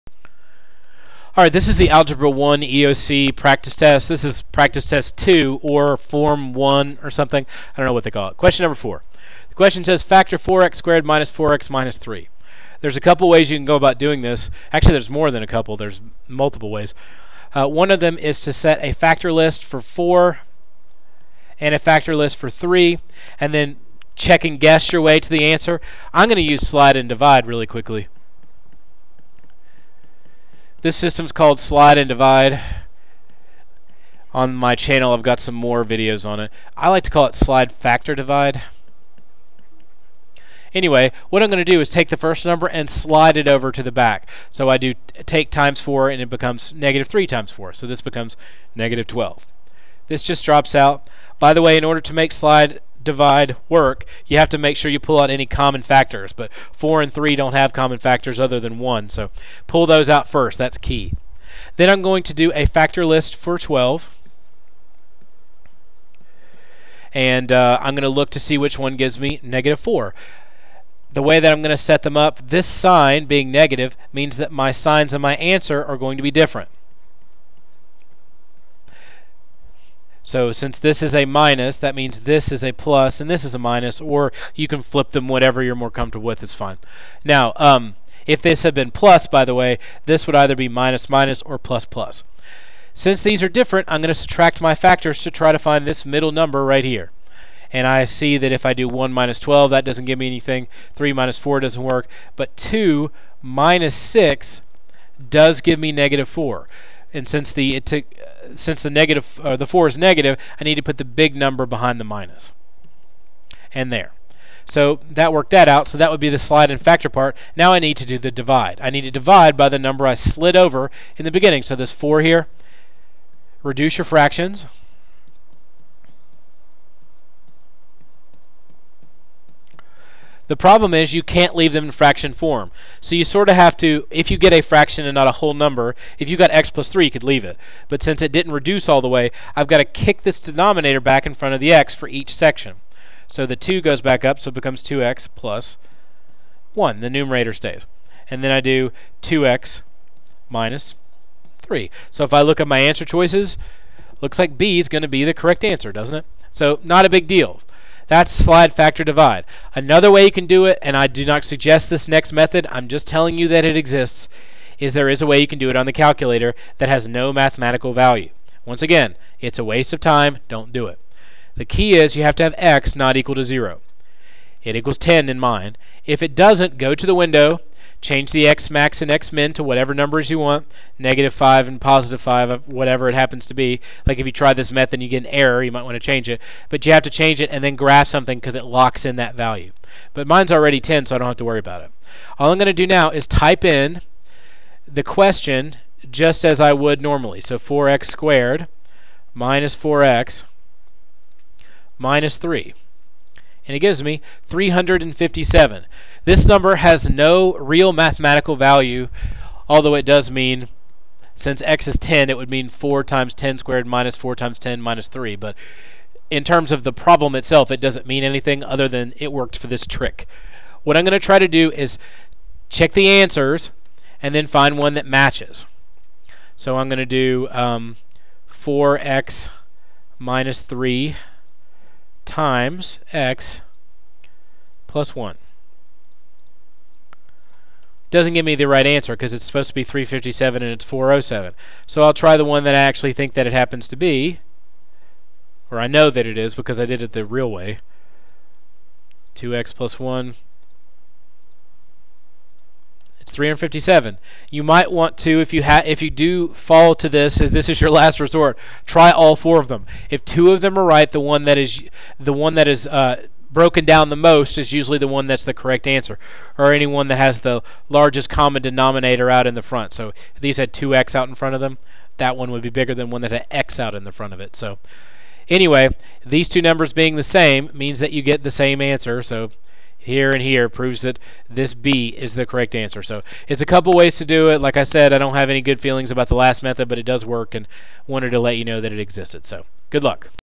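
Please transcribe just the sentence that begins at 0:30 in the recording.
This system's called Slide and Divide.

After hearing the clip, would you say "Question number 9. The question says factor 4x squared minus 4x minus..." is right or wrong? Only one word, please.
wrong.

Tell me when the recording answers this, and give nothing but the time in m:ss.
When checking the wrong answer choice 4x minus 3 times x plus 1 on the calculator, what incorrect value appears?
4:00.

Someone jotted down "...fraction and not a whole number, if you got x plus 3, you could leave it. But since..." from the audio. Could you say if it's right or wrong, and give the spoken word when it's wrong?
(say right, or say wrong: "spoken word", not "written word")
right.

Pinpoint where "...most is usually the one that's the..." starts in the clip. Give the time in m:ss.
4:24.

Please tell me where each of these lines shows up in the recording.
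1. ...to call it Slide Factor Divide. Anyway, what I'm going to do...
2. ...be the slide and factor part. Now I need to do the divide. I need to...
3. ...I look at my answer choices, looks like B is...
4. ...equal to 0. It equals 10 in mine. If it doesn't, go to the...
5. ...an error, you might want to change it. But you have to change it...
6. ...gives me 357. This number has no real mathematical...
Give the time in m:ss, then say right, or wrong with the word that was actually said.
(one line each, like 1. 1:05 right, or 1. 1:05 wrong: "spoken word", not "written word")
1. 0:37 right
2. 1:56 right
3. 2:32 right
4. 2:53 right
5. 3:05 right
6. 3:23 right.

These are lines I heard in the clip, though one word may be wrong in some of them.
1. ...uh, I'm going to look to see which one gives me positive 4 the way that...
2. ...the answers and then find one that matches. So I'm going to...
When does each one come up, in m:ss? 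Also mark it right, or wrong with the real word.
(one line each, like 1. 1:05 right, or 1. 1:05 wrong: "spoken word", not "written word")
1. 1:07 wrong: "negative", not "positive"
2. 3:42 right.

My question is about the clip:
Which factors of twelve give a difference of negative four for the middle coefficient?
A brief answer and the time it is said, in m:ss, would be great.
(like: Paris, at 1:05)
2 and 6, at 1:42.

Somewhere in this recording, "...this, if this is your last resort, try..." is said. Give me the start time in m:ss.
4:17.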